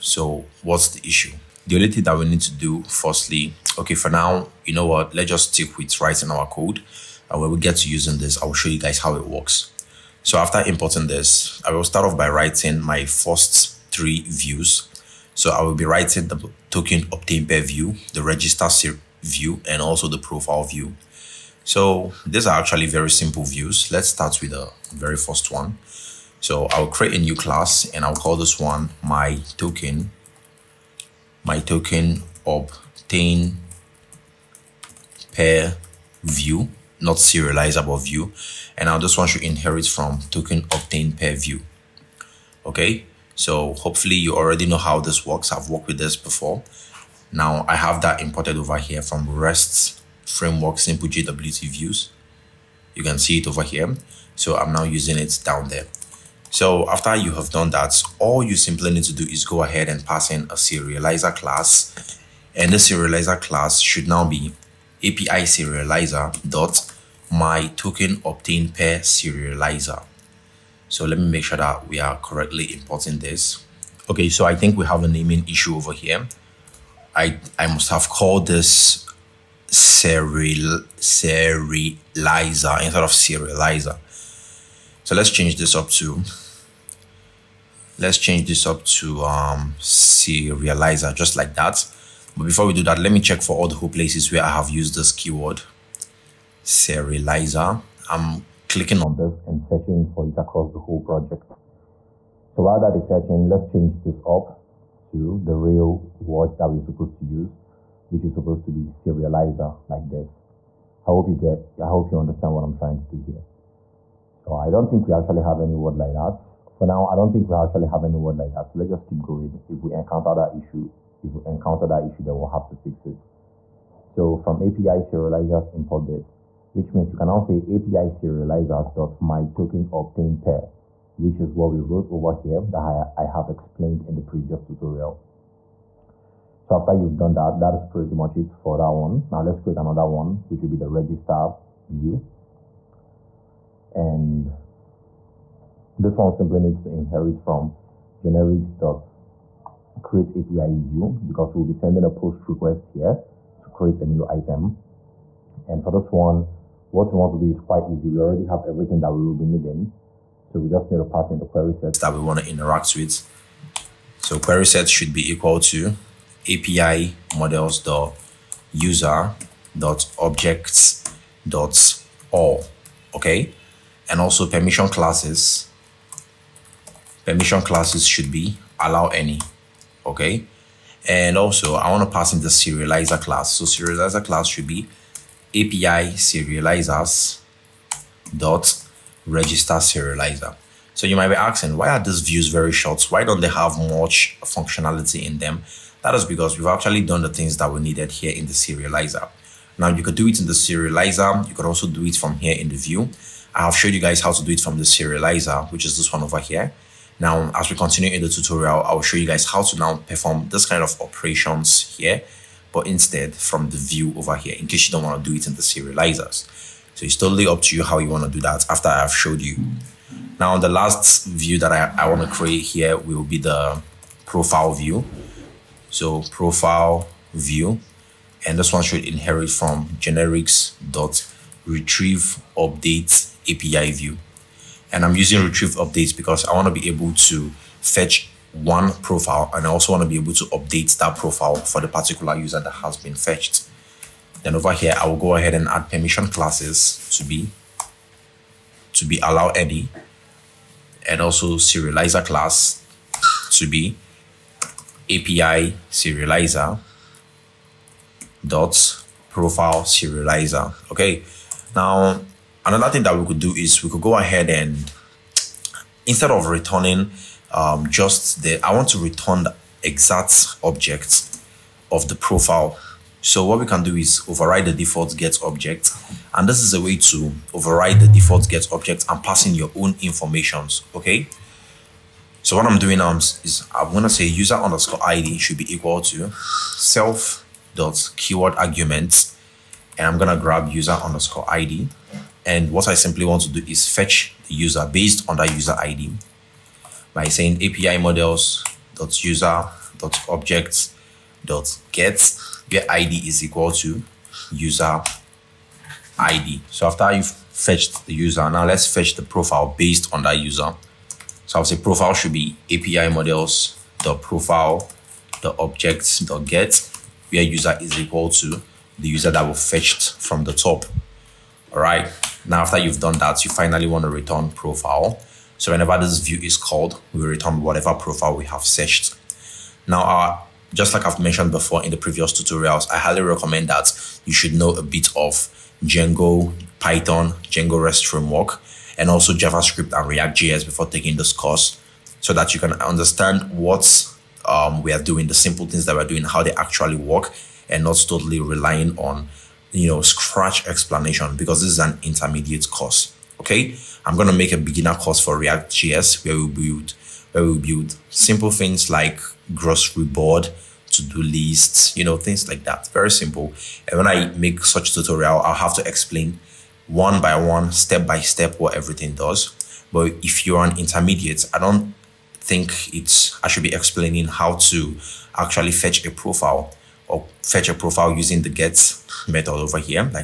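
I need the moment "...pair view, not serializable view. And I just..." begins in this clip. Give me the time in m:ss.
0:35.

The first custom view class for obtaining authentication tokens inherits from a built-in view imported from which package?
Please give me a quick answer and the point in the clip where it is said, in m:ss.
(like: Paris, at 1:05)
REST framework simple JWT views, at 0:49.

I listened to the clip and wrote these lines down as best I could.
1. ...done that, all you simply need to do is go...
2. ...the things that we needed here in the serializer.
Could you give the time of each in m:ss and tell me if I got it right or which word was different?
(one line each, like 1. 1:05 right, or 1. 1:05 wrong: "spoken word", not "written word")
1. 0:57 right
2. 3:17 right.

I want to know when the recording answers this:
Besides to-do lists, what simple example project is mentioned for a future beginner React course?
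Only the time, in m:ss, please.
5:59.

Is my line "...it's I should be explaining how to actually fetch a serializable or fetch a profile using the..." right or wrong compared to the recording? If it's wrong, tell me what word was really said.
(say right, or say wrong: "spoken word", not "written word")
wrong: "profile", not "serializable".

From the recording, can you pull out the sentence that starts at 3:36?
So it's totally up to you how you want to do that after I've showed you.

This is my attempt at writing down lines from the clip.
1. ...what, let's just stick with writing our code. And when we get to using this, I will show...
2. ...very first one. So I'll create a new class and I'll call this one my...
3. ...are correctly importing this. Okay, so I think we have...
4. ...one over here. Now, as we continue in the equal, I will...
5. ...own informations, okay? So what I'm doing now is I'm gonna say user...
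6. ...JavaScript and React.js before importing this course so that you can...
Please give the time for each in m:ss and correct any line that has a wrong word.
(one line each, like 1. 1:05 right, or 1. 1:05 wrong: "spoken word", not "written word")
1. 0:04 right
2. 0:24 right
3. 1:11 right
4. 3:26 wrong: "tutorial", not "equal"
5. 4:39 right
6. 5:39 wrong: "taking", not "importing".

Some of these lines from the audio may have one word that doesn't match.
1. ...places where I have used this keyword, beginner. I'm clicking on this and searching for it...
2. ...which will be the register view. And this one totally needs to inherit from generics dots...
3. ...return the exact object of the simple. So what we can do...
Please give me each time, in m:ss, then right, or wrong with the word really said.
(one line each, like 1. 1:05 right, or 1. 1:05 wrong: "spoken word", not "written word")
1. 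1:33 wrong: "serializer", not "beginner"
2. 2:20 wrong: "simply", not "totally"
3. 4:28 wrong: "profile", not "simple".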